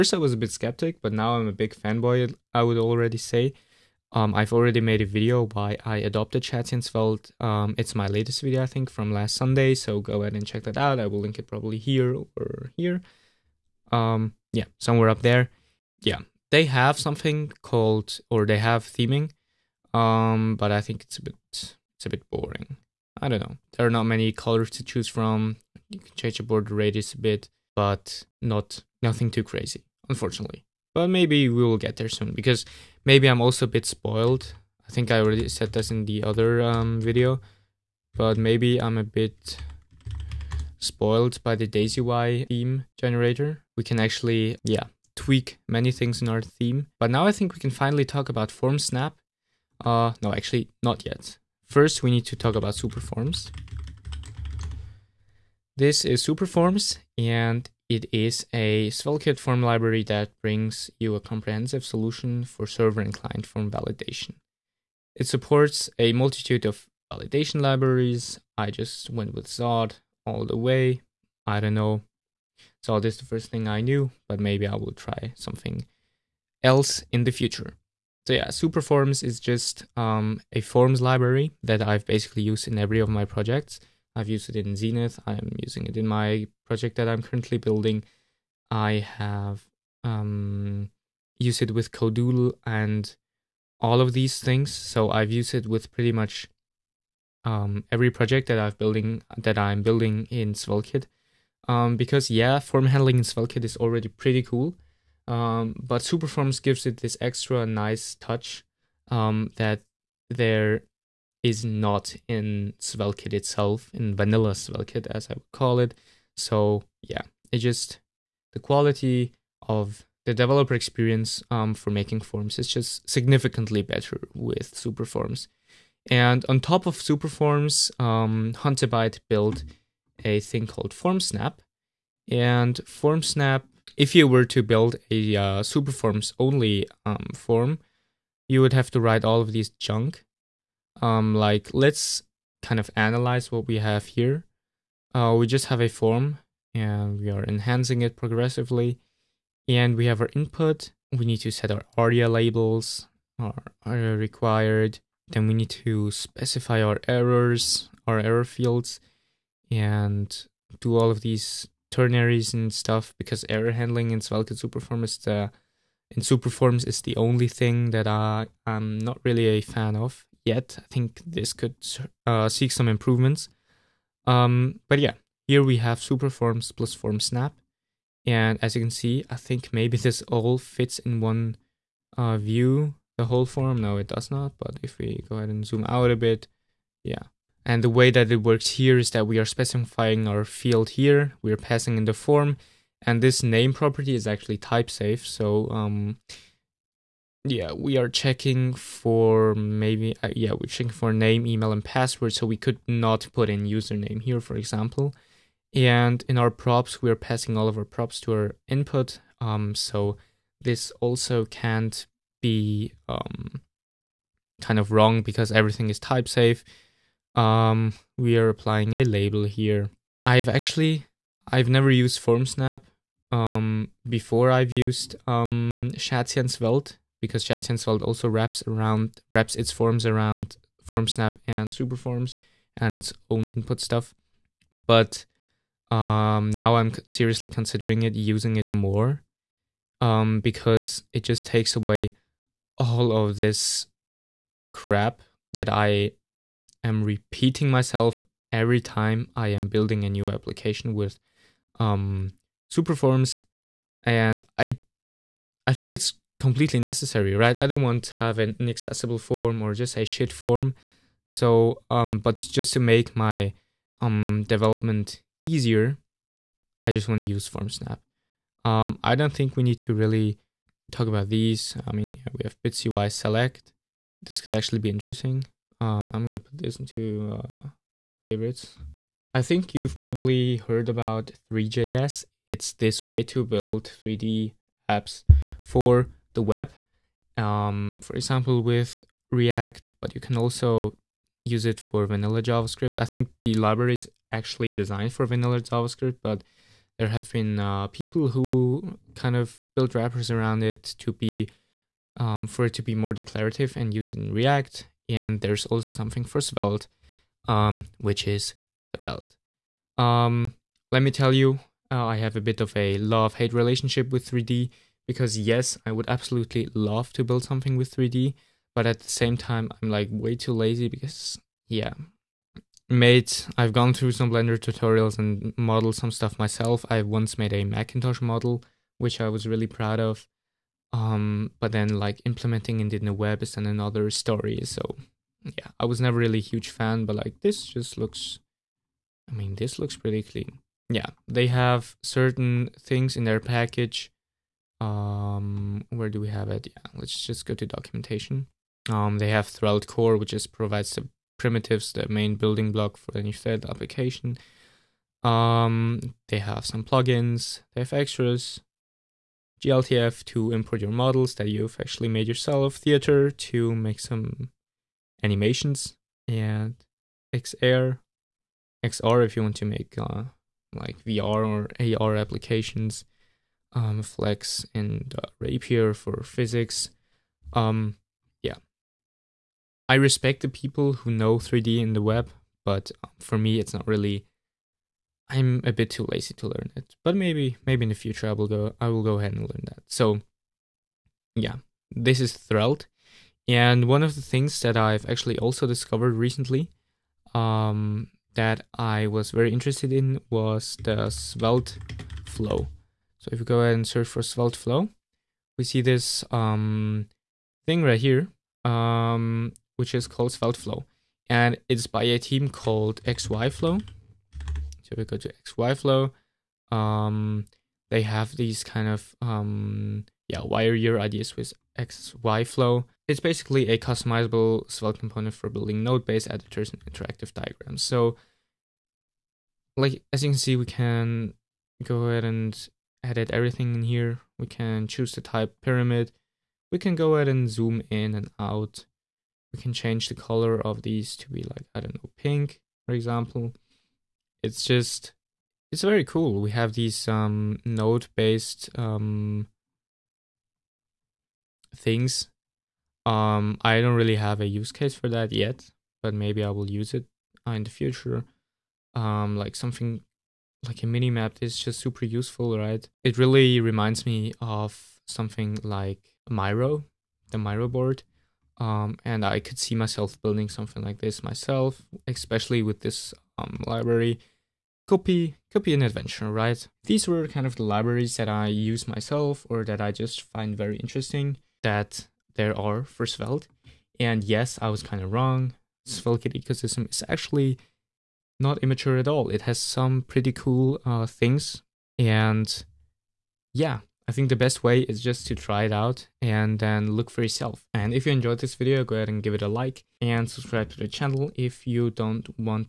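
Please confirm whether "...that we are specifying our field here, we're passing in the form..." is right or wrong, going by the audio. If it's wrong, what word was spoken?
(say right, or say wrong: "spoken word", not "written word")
right.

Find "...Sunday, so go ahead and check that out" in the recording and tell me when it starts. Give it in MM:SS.
00:09.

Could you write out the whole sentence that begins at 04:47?
Um, for example, with React, but you can also use it for vanilla JavaScript.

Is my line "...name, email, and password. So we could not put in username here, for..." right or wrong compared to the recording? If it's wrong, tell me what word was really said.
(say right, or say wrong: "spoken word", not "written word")
right.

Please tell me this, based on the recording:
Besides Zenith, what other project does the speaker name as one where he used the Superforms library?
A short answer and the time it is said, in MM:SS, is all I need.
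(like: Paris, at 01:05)
Codoodle, at 01:31.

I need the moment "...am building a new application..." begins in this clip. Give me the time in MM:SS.
04:09.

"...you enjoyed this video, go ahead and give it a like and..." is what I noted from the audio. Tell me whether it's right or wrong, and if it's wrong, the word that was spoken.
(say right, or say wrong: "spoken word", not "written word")
right.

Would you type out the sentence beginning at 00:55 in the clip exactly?
This is superforms, and it is a SvelteKit form library that brings you a comprehensive solution for server and client form validation.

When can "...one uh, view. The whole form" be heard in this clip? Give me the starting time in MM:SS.
03:01.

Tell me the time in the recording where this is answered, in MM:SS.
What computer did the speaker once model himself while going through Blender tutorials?
05:27.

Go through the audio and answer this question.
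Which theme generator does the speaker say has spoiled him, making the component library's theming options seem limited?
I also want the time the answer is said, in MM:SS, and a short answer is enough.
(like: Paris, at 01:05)
DaisyUI theme generator, at 00:41.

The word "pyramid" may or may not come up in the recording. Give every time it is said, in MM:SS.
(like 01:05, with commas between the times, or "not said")
07:15.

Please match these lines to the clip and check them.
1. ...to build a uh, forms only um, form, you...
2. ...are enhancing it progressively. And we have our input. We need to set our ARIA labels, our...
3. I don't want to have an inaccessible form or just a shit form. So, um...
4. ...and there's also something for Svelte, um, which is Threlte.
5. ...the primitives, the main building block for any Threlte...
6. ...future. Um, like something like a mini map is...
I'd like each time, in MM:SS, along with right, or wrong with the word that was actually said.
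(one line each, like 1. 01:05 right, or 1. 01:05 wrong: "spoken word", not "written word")
1. 02:14 wrong: "superforms", not "forms"
2. 02:27 right
3. 04:17 right
4. 05:05 right
5. 05:50 right
6. 07:37 right.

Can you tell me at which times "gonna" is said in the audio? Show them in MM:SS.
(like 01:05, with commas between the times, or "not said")
04:36.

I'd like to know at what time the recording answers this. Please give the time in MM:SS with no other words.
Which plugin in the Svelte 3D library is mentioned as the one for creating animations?
06:02.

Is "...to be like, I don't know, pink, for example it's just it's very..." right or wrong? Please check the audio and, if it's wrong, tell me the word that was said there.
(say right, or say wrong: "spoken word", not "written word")
right.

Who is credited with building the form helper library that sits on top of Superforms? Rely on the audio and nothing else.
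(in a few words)
Huntabyte.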